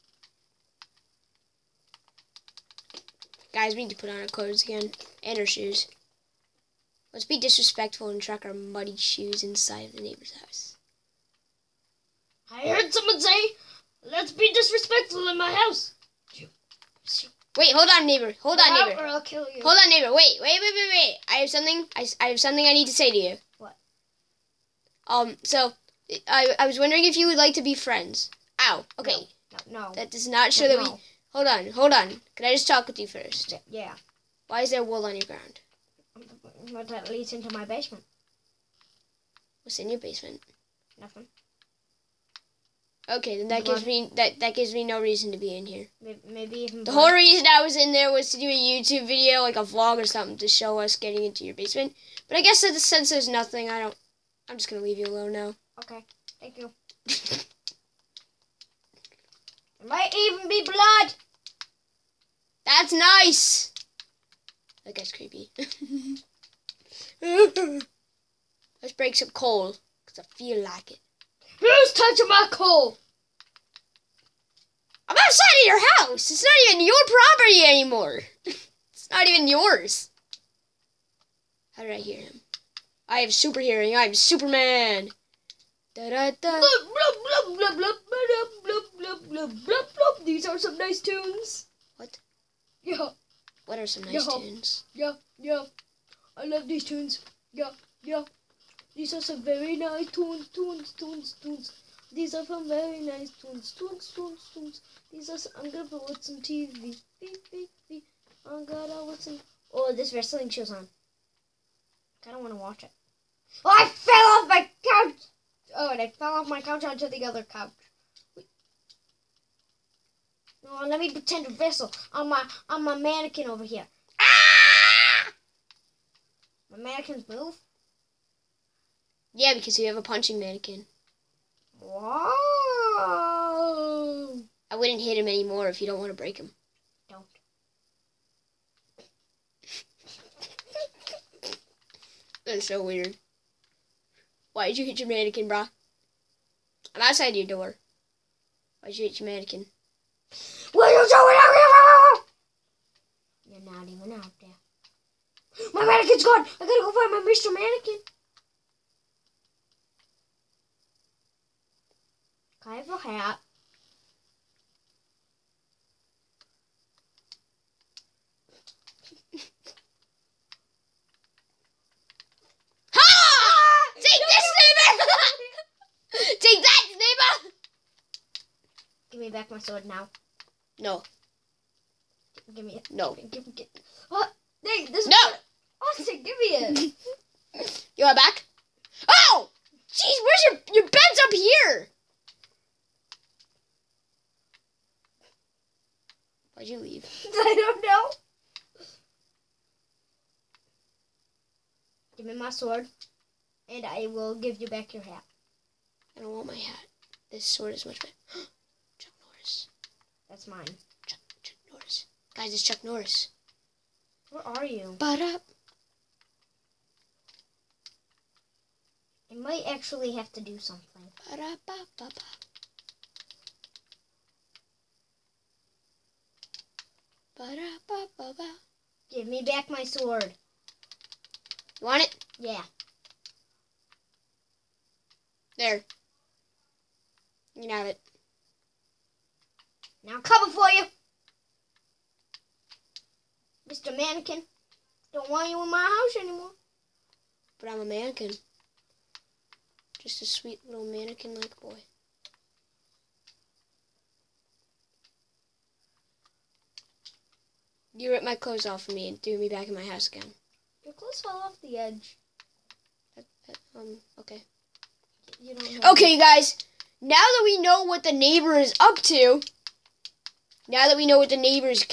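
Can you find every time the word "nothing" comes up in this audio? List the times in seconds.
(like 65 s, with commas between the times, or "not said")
40 s, 53 s.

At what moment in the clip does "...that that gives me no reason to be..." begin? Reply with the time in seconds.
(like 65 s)
44 s.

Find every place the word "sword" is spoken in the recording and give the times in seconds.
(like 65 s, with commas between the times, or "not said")
179 s, 202 s, 207 s, 229 s.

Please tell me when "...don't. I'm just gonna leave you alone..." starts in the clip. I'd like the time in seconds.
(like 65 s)
53 s.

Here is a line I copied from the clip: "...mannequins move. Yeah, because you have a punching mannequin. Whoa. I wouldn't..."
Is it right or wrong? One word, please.
right.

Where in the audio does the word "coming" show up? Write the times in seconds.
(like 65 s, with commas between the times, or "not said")
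240 s.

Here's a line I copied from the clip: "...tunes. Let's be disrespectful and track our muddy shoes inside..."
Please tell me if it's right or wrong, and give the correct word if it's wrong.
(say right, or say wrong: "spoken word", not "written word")
wrong: "shoes", not "tunes".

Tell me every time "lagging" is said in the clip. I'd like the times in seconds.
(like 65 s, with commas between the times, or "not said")
not said.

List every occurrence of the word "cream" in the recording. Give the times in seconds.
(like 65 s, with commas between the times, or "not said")
not said.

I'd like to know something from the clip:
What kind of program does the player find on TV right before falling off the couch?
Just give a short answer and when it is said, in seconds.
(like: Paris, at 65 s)
wrestling show, at 109 s.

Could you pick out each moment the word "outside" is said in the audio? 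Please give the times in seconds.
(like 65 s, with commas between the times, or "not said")
75 s, 147 s.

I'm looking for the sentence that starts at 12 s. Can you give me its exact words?
I heard someone say, let's be disrespectful in my house.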